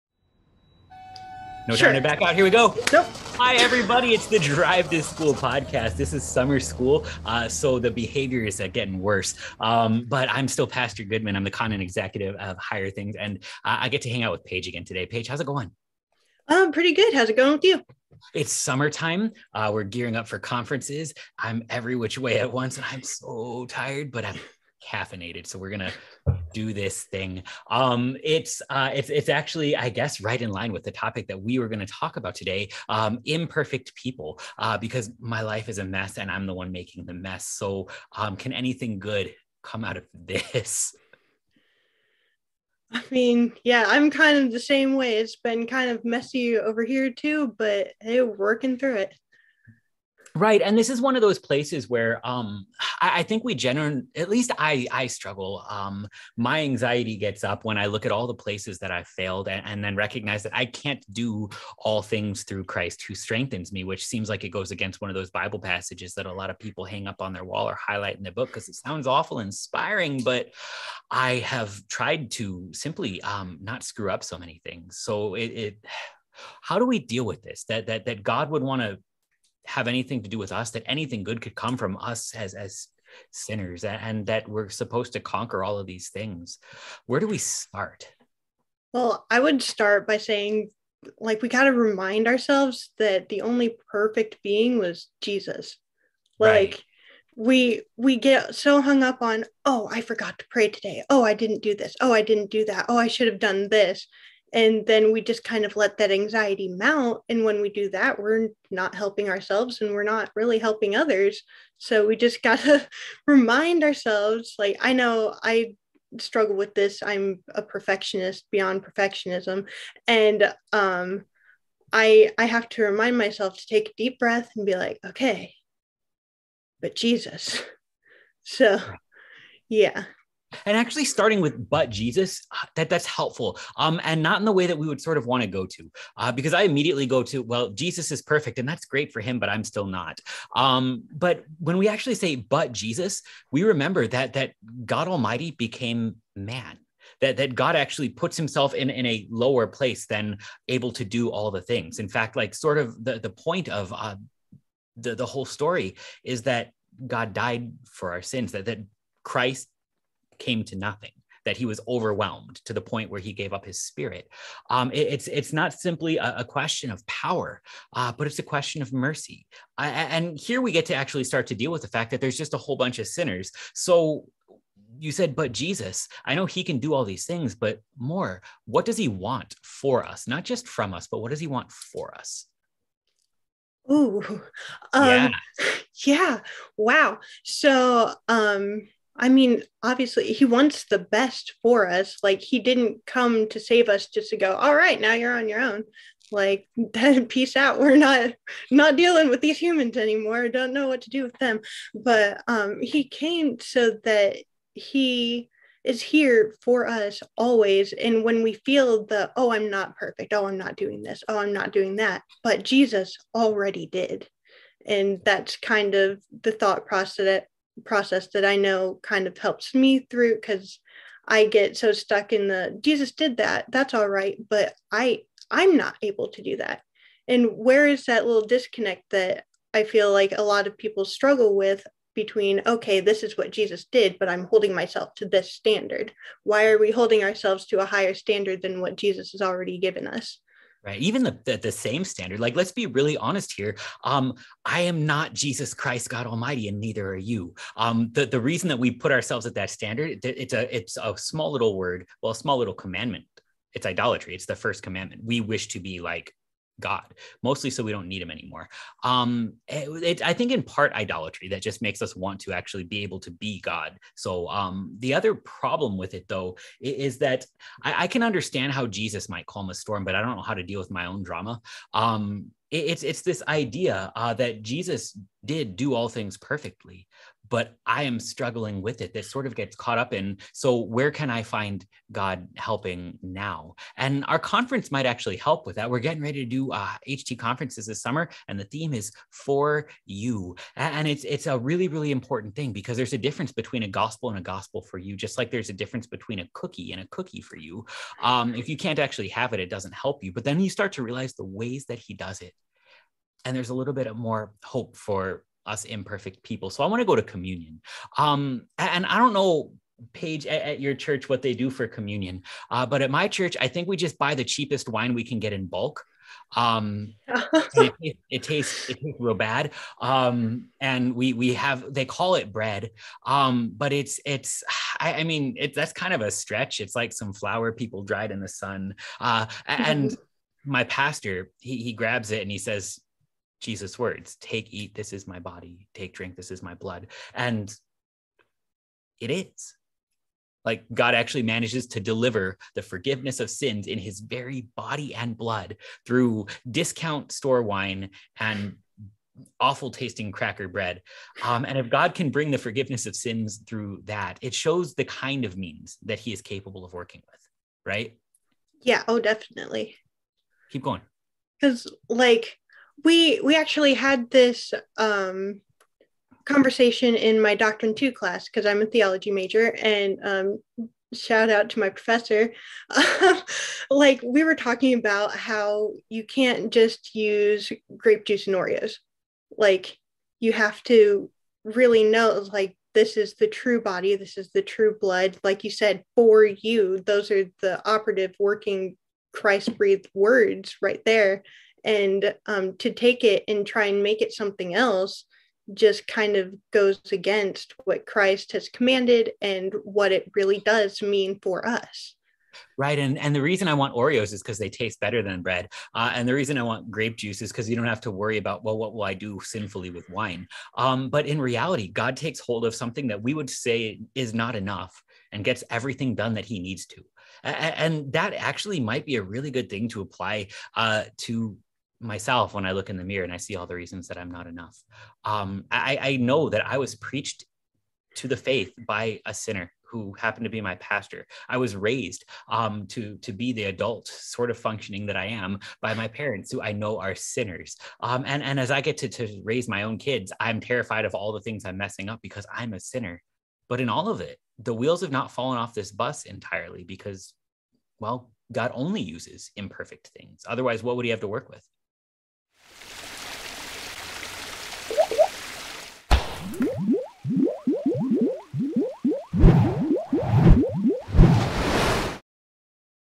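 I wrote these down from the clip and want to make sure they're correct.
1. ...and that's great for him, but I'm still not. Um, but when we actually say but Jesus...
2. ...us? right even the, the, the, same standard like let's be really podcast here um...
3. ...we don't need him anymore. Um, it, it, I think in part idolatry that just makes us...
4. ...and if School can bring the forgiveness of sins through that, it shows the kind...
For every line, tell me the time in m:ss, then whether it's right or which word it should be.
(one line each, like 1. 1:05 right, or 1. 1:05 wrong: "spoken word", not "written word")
1. 2:18 right
2. 4:00 wrong: "honest", not "podcast"
3. 4:17 right
4. 5:51 wrong: "God", not "School".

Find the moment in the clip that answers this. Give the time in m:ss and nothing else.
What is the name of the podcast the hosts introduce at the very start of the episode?
0:04.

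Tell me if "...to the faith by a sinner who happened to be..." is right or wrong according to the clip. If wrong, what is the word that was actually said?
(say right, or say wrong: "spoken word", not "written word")
right.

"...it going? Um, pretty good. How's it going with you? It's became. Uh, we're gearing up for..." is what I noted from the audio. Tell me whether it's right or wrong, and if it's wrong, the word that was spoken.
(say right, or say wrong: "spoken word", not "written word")
wrong: "summertime", not "became".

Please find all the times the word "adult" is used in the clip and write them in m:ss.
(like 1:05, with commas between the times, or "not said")
7:13.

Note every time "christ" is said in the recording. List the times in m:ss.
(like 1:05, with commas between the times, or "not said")
1:02, 2:39, 4:05, 6:29, 6:38.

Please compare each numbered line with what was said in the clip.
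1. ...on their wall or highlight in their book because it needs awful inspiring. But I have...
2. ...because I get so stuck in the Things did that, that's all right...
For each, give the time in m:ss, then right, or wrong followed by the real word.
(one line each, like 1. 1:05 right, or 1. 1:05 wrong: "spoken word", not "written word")
1. 1:07 wrong: "sounds", not "needs"
2. 3:40 wrong: "Jesus", not "Things".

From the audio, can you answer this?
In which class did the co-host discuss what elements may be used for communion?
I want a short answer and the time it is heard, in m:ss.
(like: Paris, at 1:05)
Doctrine Two, at 6:07.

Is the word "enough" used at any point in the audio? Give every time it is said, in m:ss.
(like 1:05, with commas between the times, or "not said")
6:54, 7:04.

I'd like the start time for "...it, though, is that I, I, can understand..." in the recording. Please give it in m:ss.
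4:26.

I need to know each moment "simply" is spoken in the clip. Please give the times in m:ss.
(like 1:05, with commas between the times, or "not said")
1:12, 2:45.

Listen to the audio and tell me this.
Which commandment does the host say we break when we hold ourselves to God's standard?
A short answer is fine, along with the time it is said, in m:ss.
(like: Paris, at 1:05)
the first commandment, at 4:14.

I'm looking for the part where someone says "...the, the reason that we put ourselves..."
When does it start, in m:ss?
4:08.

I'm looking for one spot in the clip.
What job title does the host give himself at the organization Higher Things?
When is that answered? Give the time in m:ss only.
0:11.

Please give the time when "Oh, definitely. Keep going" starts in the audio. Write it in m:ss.
5:59.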